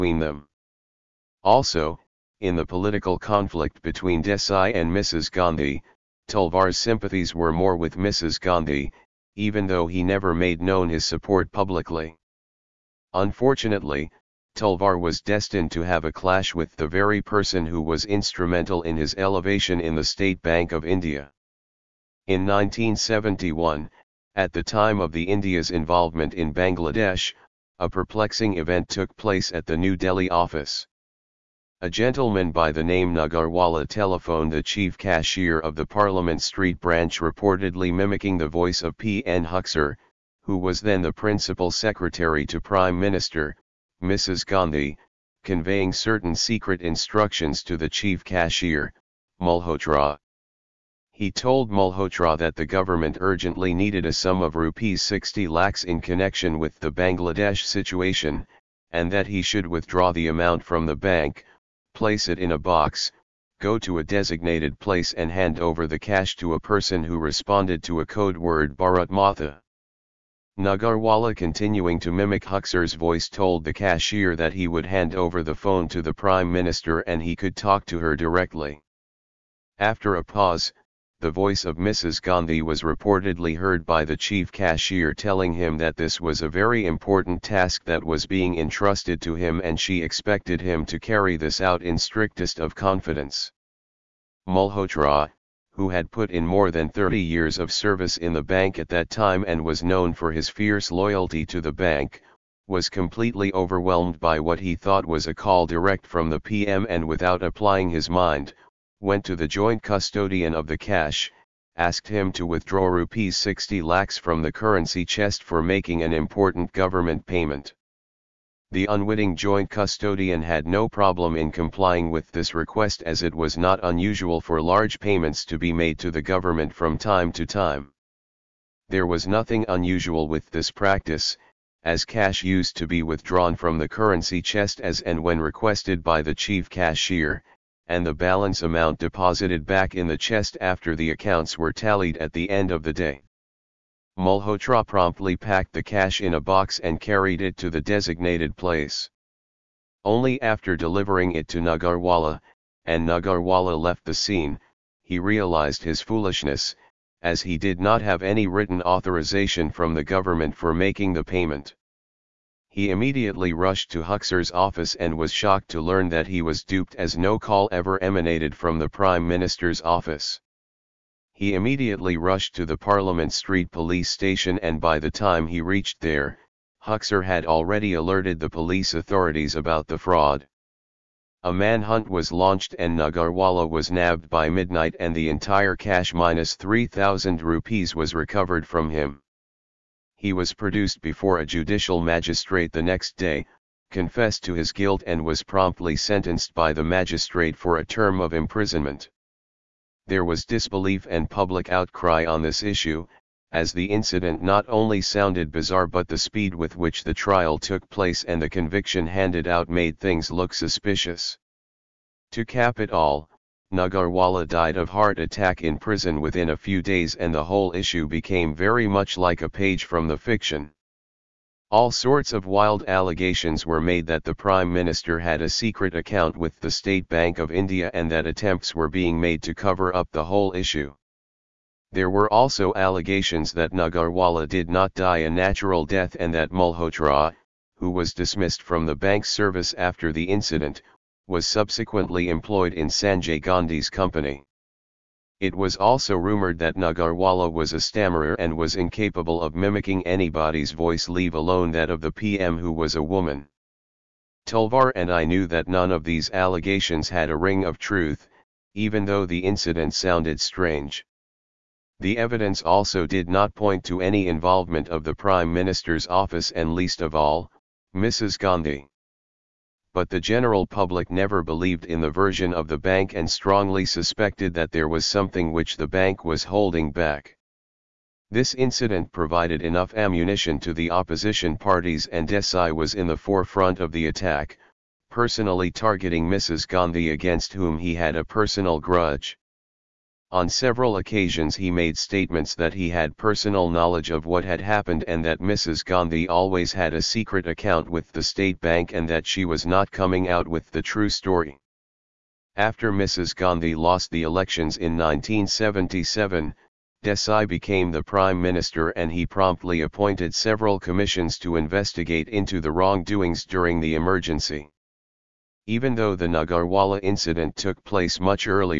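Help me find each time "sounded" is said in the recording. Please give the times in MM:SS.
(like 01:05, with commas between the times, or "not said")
03:25, 04:19.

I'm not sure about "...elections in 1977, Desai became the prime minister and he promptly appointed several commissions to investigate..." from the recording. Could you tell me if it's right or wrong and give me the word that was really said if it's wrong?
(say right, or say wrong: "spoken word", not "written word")
right.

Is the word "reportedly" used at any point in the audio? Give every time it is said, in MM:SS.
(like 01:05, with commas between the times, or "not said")
00:37, 01:22.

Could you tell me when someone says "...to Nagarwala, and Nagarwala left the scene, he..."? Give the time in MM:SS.
02:31.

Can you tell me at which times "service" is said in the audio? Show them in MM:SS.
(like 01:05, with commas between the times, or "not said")
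01:37, 03:59.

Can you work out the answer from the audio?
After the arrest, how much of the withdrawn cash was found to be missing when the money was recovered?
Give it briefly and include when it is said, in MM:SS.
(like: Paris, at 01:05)
3,000 rupees, at 03:06.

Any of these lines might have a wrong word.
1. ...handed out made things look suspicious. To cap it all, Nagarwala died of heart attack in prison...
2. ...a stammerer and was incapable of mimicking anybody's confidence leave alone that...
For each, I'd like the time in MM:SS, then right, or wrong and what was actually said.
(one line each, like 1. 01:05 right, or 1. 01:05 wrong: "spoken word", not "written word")
1. 03:29 right
2. 04:07 wrong: "voice", not "confidence".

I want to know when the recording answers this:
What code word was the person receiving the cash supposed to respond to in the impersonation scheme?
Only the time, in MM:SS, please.
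01:08.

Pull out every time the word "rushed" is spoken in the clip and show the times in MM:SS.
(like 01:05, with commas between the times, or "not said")
02:43, 02:52.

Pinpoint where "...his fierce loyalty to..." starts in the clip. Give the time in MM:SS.
01:40.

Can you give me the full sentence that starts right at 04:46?
Gandhi against whom he had a personal grudge.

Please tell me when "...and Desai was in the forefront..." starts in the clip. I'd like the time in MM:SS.
04:42.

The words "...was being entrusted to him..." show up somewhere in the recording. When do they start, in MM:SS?
01:28.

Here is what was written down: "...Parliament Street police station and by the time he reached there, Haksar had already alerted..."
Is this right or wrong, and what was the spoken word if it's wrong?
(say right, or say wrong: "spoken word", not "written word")
right.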